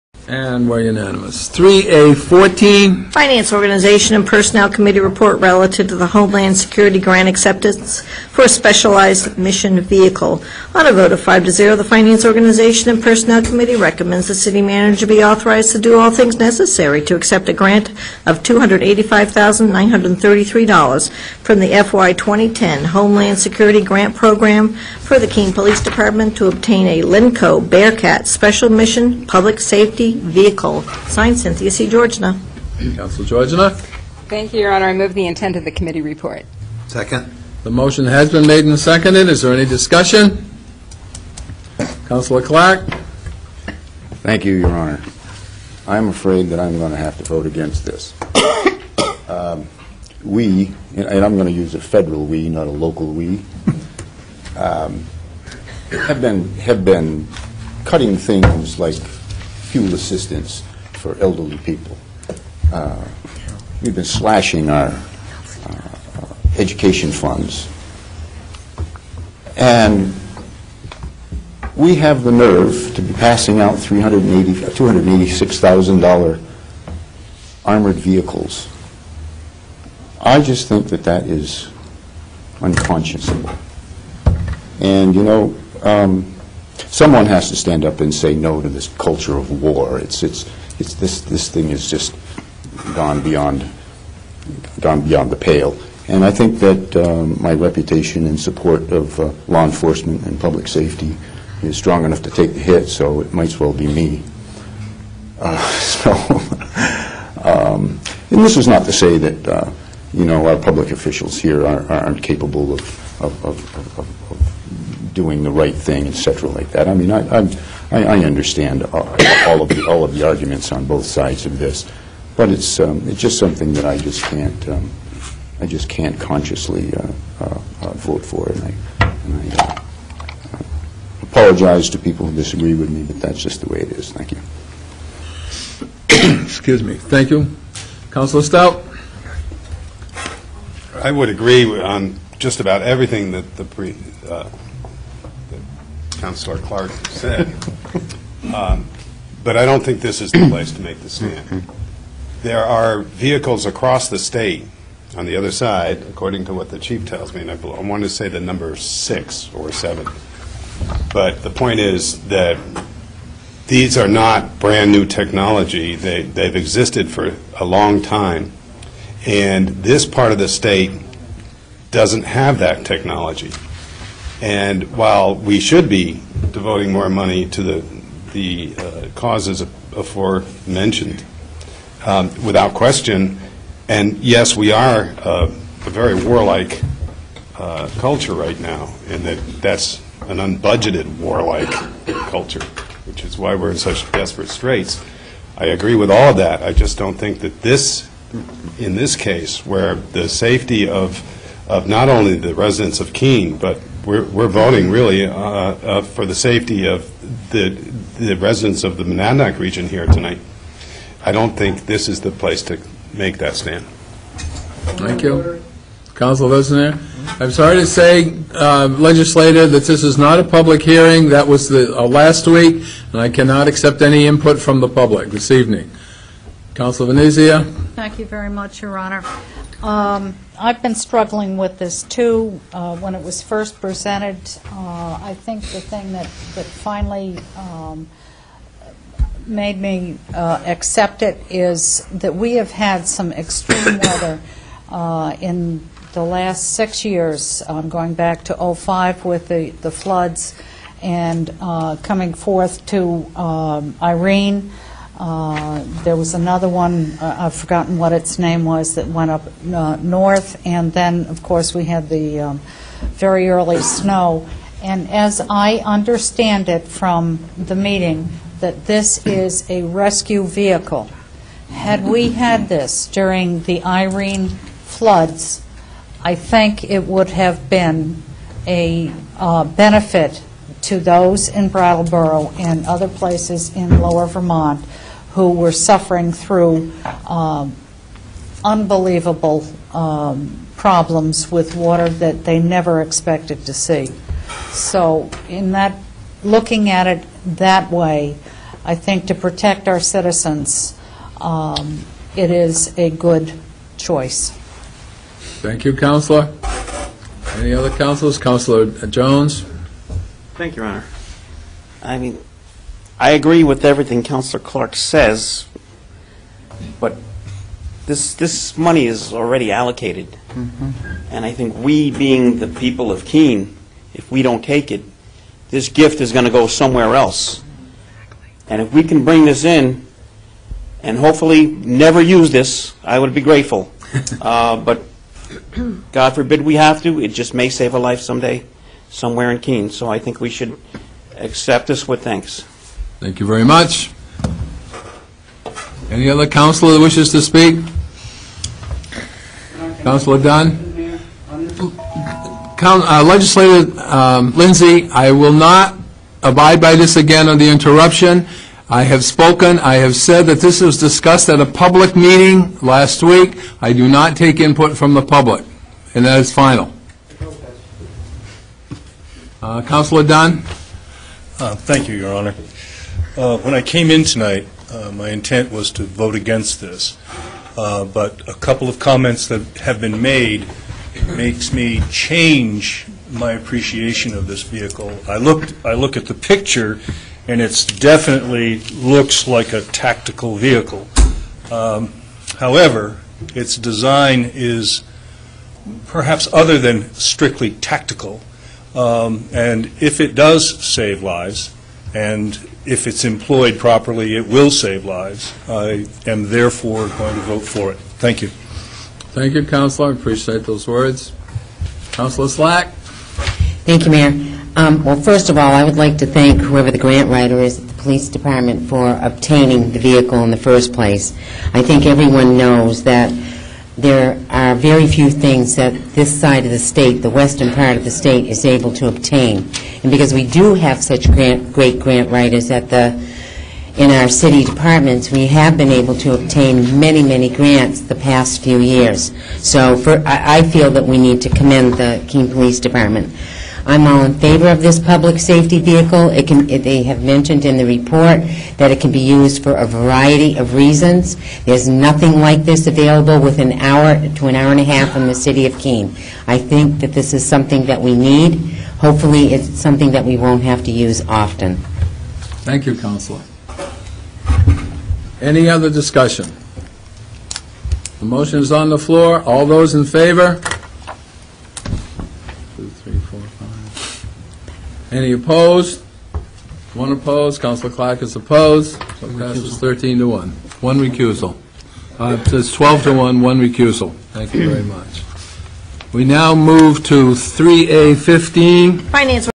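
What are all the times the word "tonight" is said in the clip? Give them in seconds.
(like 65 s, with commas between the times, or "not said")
210 s, 374 s.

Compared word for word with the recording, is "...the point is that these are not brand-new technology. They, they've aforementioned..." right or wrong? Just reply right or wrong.
wrong.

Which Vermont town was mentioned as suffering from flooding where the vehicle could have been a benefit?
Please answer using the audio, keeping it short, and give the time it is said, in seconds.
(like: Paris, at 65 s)
Brattleboro, at 281 s.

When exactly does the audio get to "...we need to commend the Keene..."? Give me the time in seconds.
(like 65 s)
441 s.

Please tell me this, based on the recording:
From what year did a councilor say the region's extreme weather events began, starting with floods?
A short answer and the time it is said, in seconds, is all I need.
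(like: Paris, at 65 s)
2005, at 248 s.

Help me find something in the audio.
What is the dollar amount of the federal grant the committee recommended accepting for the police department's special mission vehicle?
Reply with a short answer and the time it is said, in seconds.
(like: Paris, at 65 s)
$285,933, at 18 s.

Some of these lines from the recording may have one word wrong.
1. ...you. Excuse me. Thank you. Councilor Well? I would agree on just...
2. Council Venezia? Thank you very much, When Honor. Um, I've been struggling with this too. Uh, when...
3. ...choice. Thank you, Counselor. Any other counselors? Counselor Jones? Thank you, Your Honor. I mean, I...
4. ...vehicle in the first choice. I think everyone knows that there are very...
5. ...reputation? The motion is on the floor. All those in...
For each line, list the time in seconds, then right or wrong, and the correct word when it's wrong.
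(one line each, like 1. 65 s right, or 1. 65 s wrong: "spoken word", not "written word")
1. 134 s wrong: "Stout", not "Well"
2. 226 s wrong: "Your", not "When"
3. 303 s right
4. 419 s wrong: "place", not "choice"
5. 465 s wrong: "discussion", not "reputation".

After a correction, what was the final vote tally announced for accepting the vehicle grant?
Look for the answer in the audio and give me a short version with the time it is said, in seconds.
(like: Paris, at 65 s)
12 to 1, at 482 s.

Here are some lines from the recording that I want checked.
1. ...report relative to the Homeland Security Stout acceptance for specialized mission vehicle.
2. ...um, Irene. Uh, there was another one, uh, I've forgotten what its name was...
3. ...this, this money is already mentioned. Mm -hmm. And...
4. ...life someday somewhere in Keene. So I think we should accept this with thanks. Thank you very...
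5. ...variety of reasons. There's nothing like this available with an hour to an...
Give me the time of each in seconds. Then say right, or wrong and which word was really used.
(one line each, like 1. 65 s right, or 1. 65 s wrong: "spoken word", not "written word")
1. 5 s wrong: "Grant", not "Stout"
2. 253 s right
3. 318 s wrong: "allocated", not "mentioned"
4. 337 s right
5. 449 s right.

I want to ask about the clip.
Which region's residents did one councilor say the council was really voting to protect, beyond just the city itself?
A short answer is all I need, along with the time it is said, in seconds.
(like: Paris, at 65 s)
Monadnock region, at 209 s.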